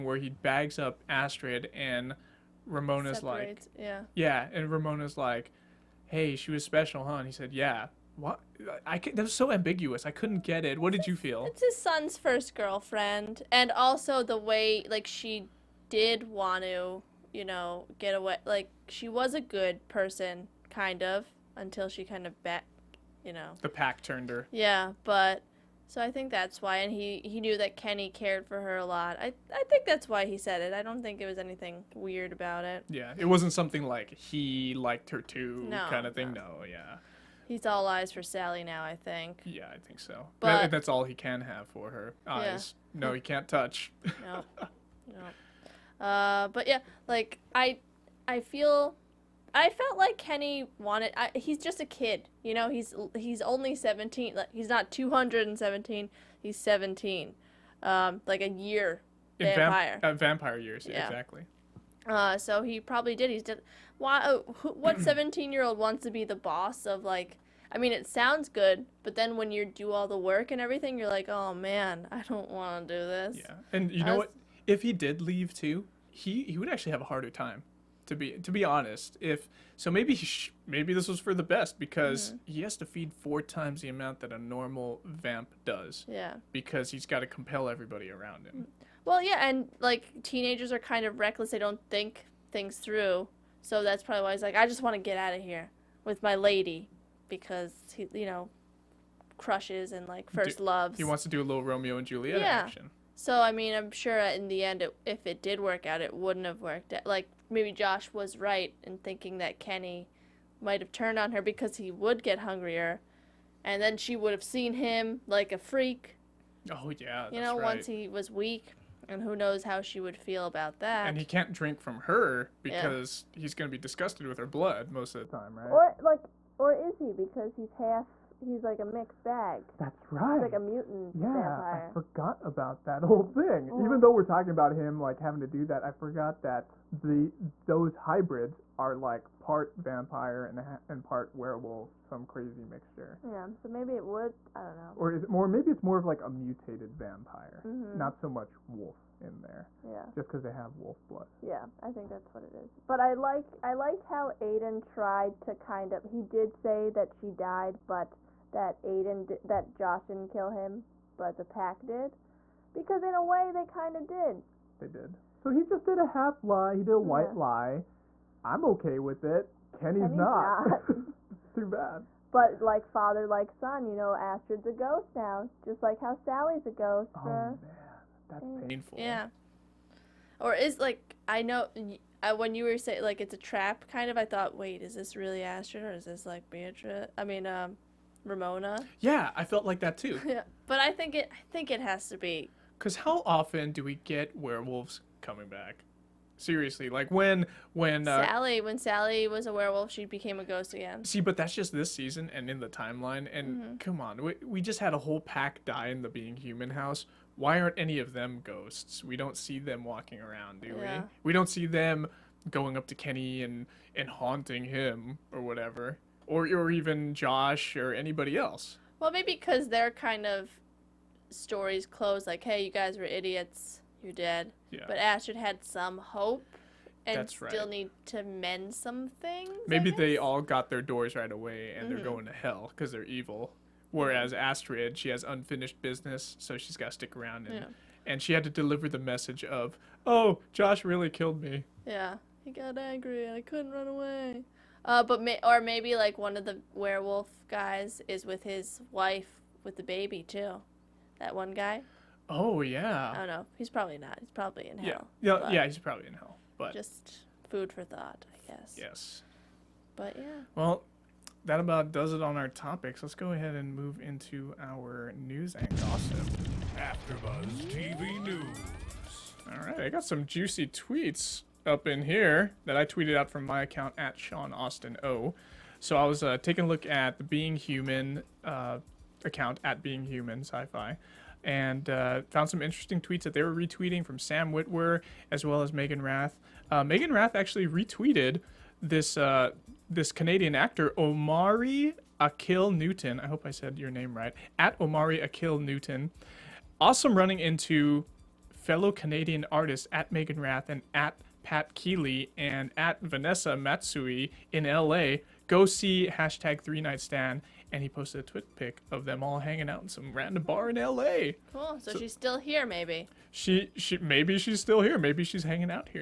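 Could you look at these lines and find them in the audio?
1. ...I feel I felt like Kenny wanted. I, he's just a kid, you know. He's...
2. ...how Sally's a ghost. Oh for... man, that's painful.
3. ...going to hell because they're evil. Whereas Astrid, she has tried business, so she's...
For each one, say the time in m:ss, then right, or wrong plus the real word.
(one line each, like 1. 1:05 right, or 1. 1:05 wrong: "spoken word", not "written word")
1. 0:48 right
2. 2:55 right
3. 3:52 wrong: "unfinished", not "tried".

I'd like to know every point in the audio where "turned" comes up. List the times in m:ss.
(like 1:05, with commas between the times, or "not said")
0:24, 1:50.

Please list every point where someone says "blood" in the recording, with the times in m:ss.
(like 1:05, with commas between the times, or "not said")
2:04, 2:31.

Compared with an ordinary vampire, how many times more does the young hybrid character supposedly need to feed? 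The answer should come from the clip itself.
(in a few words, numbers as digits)
4 times.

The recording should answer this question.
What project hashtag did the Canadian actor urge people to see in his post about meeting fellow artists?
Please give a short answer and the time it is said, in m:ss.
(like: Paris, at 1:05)
Three Night Stand, at 5:06.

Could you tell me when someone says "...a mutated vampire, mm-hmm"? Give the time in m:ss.
2:26.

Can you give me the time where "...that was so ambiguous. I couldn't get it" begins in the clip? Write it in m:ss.
0:08.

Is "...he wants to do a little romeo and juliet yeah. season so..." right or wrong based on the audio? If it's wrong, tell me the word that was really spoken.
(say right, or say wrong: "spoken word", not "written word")
wrong: "action", not "season".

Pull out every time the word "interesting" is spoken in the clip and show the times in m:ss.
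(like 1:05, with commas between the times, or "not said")
4:42.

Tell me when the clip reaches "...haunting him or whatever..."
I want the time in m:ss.
3:34.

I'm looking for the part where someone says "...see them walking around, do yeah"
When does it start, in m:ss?
3:29.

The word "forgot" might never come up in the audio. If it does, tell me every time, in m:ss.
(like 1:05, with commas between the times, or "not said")
2:11, 2:15.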